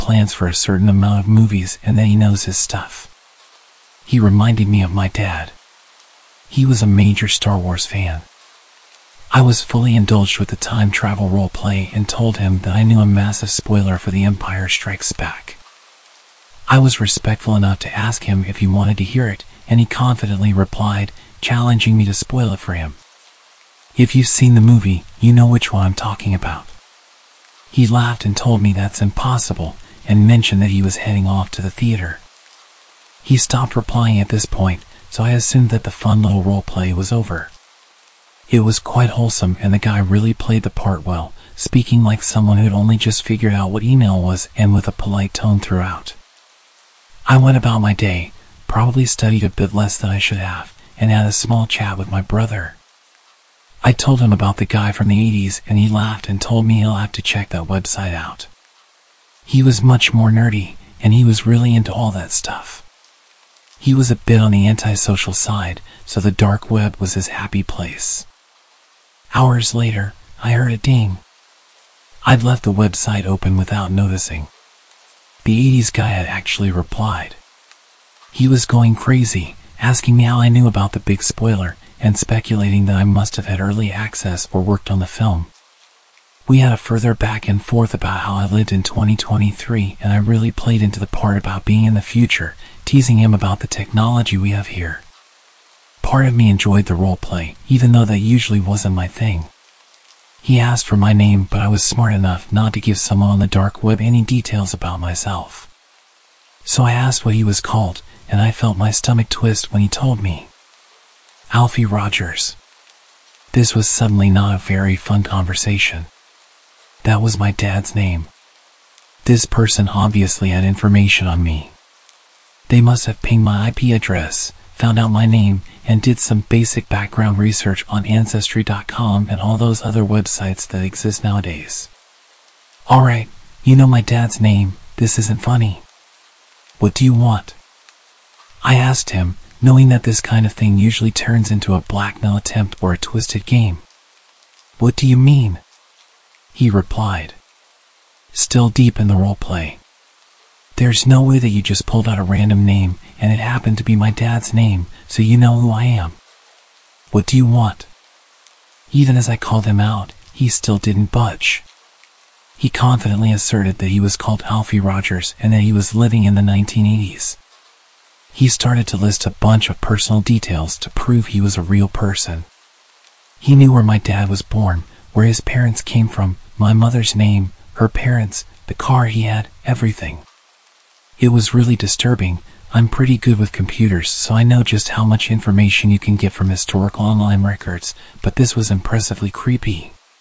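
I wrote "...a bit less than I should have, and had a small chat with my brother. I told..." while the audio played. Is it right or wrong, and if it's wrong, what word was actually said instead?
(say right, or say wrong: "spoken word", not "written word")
right.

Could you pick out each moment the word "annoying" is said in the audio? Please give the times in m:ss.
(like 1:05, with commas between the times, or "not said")
not said.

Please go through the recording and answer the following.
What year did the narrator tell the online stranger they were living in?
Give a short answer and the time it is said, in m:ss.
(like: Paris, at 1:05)
2023, at 1:28.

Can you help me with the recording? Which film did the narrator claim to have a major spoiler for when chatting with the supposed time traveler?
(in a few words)
The Empire Strikes Back.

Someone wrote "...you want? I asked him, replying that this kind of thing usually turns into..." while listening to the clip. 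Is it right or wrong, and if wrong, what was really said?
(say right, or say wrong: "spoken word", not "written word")
wrong: "knowing", not "replying".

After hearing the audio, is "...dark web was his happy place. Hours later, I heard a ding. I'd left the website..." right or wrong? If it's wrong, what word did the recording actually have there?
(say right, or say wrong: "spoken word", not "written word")
right.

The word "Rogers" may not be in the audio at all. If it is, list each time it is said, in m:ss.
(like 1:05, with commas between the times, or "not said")
1:51, 2:44.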